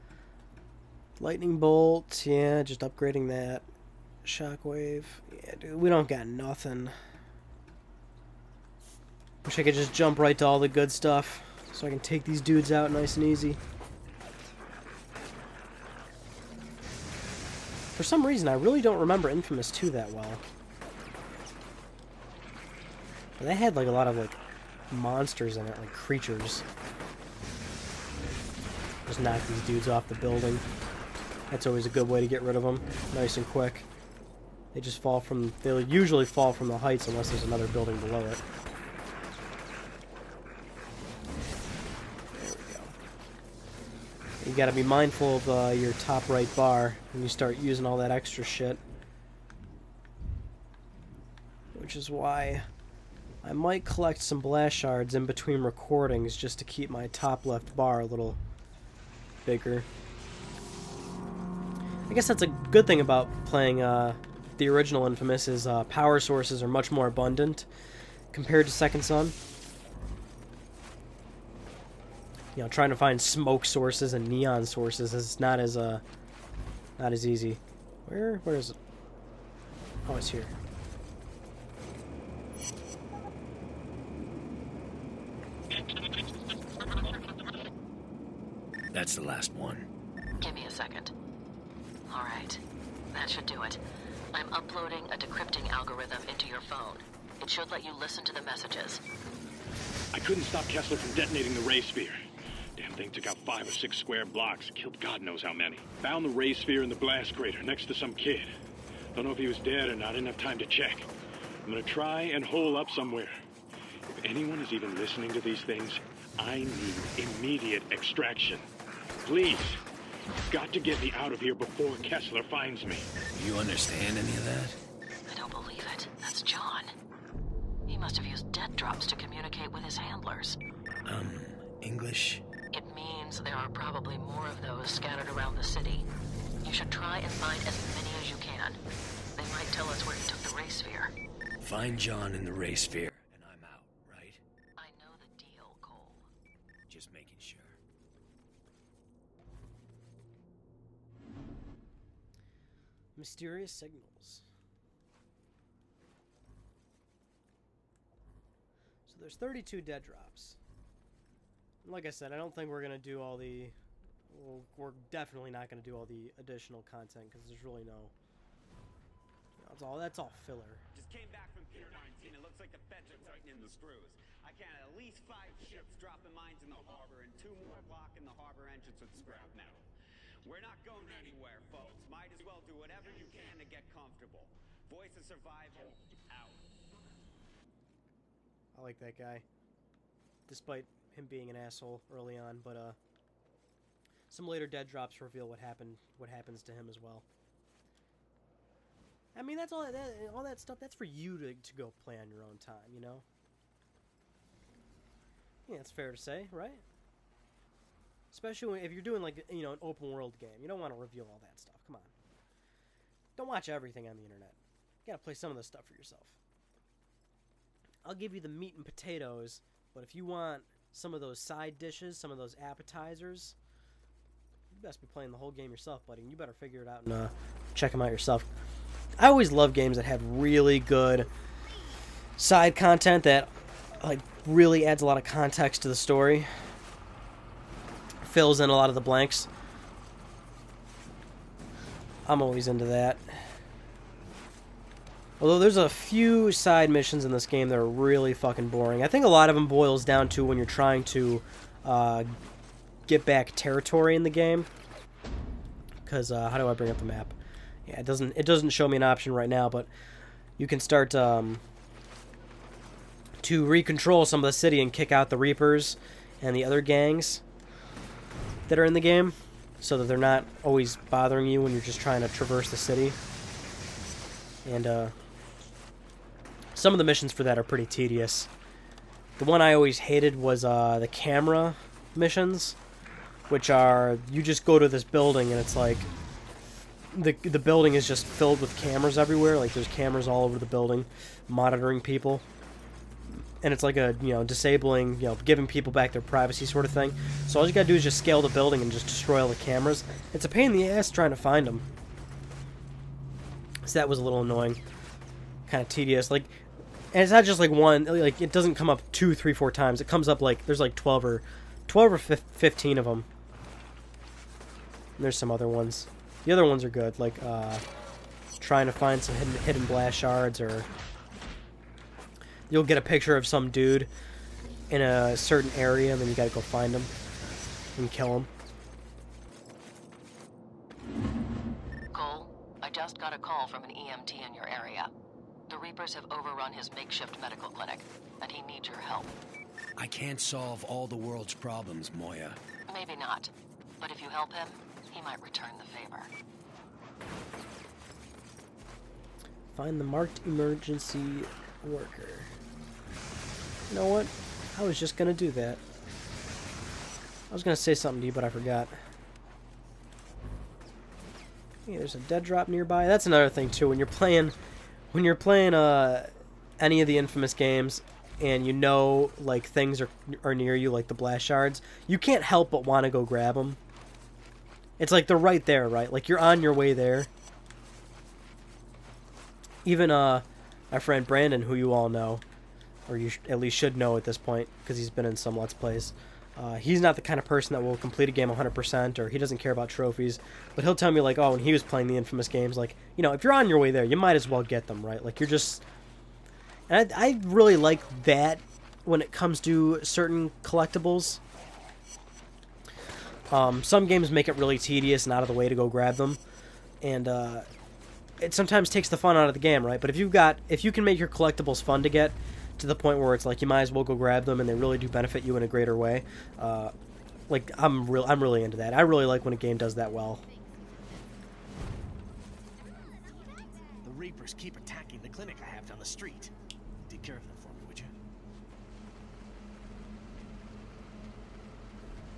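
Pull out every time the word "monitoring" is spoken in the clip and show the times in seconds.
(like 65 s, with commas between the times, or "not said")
291 s.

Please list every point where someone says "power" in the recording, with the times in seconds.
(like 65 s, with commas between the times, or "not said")
65 s.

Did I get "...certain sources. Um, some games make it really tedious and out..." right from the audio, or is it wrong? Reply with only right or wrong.
wrong.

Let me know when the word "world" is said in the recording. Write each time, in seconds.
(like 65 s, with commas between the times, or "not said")
210 s, 341 s.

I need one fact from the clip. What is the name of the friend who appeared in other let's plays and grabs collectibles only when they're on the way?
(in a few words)
Brandon.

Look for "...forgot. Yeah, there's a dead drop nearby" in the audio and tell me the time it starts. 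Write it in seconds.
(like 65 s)
358 s.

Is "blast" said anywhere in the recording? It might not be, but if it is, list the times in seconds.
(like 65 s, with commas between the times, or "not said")
54 s, 106 s, 319 s, 371 s.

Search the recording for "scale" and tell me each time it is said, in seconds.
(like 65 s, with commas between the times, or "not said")
298 s.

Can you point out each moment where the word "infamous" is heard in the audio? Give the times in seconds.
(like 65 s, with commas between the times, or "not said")
19 s, 65 s, 367 s, 392 s.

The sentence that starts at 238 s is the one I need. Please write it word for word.
Fills in a lot of the blanks.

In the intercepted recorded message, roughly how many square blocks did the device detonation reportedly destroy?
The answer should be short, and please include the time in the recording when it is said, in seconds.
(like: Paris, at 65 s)
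5 or 6, at 103 s.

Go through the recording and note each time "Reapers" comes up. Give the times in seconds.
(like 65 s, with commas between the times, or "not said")
265 s, 335 s, 424 s.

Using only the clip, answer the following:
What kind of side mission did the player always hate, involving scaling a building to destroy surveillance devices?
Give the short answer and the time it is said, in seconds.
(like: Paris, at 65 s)
Camera missions, at 281 s.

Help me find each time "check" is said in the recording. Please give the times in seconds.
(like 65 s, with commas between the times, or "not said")
110 s, 227 s.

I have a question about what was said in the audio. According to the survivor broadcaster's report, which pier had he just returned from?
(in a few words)
Pier 19.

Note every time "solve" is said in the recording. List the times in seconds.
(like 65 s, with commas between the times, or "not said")
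340 s.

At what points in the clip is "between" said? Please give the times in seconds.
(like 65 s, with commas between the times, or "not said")
55 s.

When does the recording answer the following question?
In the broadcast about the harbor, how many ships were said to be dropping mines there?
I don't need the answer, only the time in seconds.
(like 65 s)
175 s.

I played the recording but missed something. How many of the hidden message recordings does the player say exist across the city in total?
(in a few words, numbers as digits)
32.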